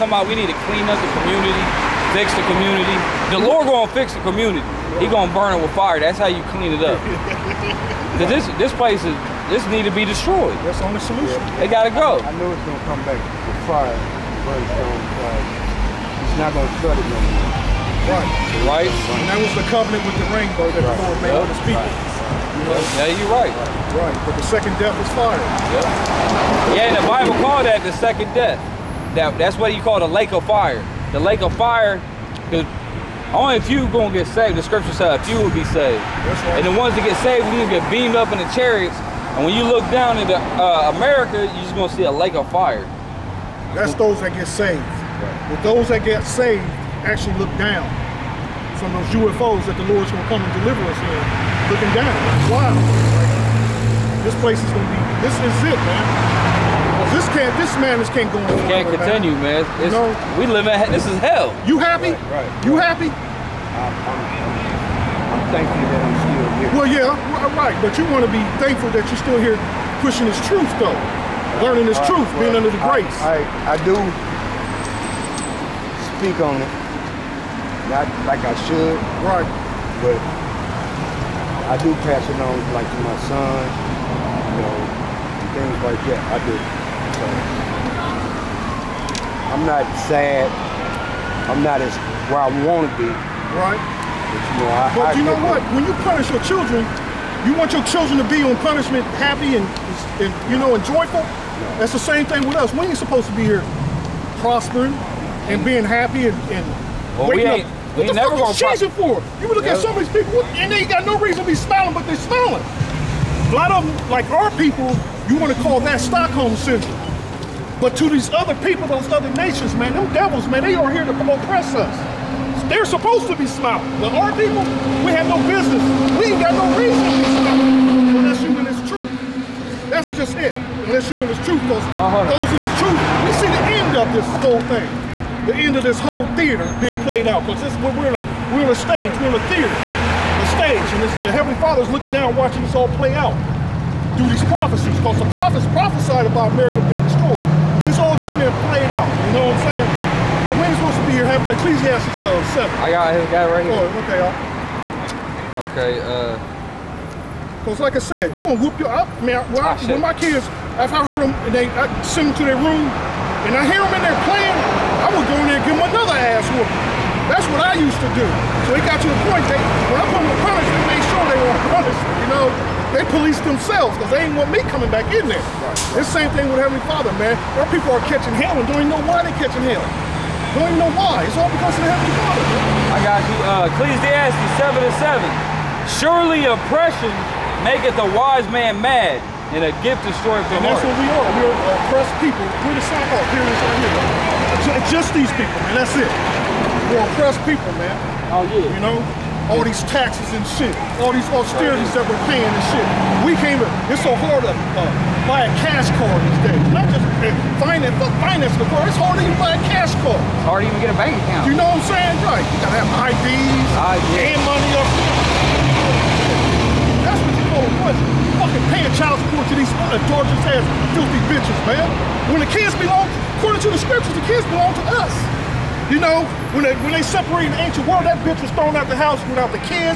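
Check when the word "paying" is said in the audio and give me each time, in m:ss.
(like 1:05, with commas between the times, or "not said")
3:22, 3:38.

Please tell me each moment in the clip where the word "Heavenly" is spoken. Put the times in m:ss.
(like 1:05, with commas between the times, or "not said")
2:21, 2:56, 3:01.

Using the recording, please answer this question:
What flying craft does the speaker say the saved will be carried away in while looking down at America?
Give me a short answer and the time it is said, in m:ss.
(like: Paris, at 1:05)
UFOs, at 0:49.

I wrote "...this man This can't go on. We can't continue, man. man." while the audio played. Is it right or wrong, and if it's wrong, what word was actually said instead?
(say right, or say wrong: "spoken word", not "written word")
right.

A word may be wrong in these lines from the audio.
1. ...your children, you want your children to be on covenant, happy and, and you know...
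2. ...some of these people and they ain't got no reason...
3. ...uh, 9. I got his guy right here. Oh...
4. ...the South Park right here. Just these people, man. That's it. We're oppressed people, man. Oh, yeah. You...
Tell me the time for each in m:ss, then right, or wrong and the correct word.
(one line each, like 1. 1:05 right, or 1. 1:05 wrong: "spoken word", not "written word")
1. 1:36 wrong: "punishment", not "covenant"
2. 1:49 right
3. 2:32 wrong: "7", not "9"
4. 3:12 right.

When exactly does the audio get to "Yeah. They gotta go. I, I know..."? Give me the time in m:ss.
0:11.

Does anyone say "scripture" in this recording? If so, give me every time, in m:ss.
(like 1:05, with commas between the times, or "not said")
0:34, 3:43.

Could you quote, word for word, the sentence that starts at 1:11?
Learning this uh, truth, well, being under the grace.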